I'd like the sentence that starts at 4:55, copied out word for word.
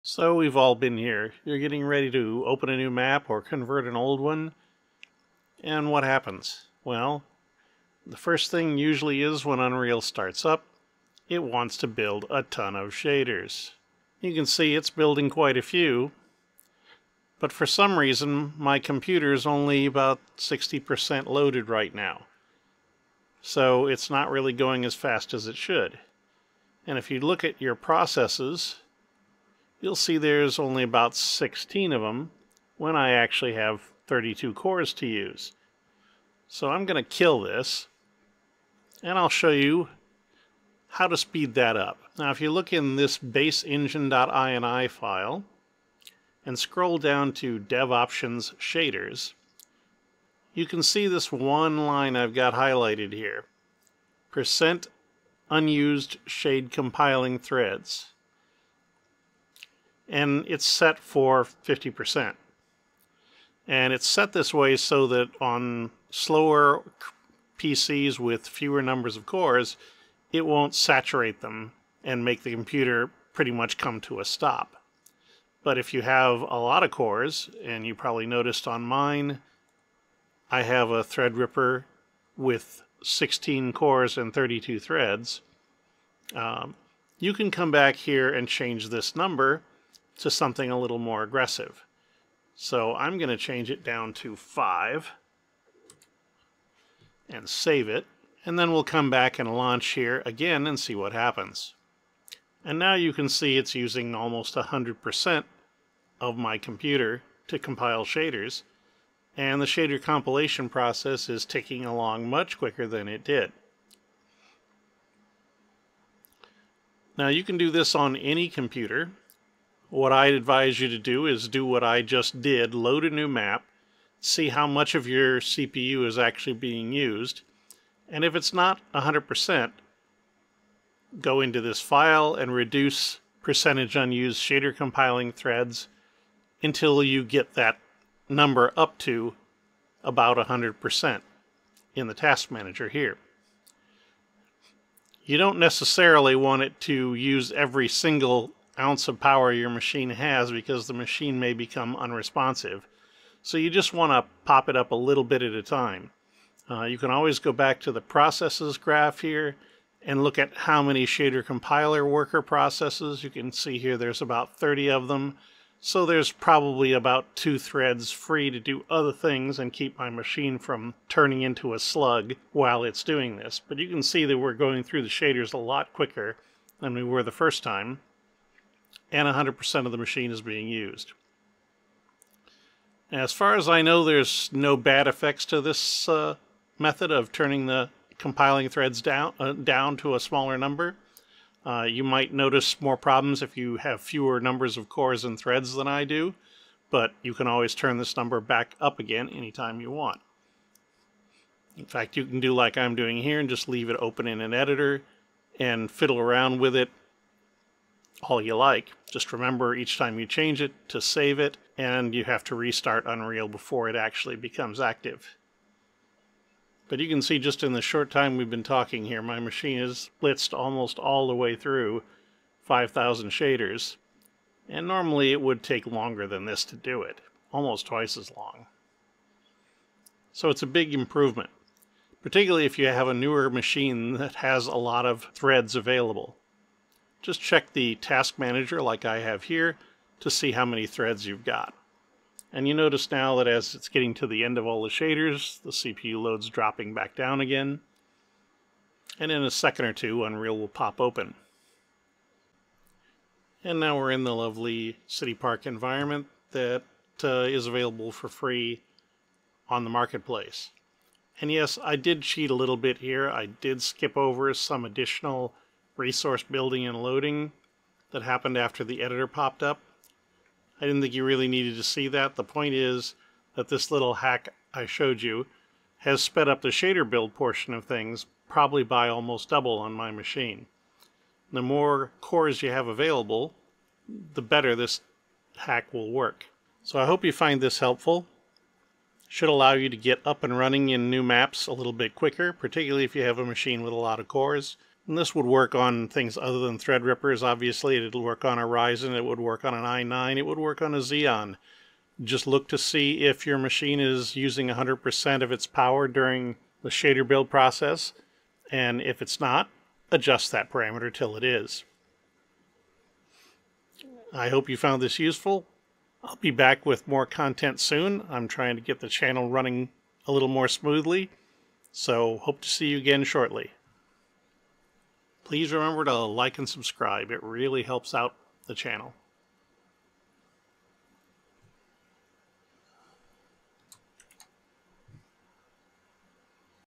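And this would work on things other than Threadrippers, obviously.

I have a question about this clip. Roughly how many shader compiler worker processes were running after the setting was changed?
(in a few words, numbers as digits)
30.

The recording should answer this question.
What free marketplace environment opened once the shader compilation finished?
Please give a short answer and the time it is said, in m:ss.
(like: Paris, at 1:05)
City Park, at 4:15.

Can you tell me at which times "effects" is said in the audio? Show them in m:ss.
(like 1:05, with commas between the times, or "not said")
3:05.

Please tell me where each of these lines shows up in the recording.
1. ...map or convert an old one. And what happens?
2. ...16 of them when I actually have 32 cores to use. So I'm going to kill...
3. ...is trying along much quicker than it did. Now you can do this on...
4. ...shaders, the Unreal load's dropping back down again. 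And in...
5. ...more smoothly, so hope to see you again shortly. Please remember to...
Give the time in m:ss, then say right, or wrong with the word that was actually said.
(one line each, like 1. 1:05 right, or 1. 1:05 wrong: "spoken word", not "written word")
1. 0:02 right
2. 0:31 right
3. 1:51 wrong: "ticking", not "trying"
4. 4:04 wrong: "CPU", not "Unreal"
5. 5:20 right.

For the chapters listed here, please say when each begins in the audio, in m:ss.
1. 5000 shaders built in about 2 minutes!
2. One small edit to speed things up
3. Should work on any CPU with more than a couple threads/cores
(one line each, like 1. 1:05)
1. 3:56
2. 0:40
3. 4:48.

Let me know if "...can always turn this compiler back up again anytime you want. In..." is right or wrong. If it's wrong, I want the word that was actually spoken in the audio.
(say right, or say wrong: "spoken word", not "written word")
wrong: "number", not "compiler".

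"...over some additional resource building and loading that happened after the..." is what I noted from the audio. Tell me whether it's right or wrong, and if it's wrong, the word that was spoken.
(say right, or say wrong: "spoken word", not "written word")
right.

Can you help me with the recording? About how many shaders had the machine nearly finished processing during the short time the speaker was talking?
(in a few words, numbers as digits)
5,000.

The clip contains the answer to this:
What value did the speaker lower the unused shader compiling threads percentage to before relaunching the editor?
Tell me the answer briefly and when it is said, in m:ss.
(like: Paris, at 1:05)
5, at 1:34.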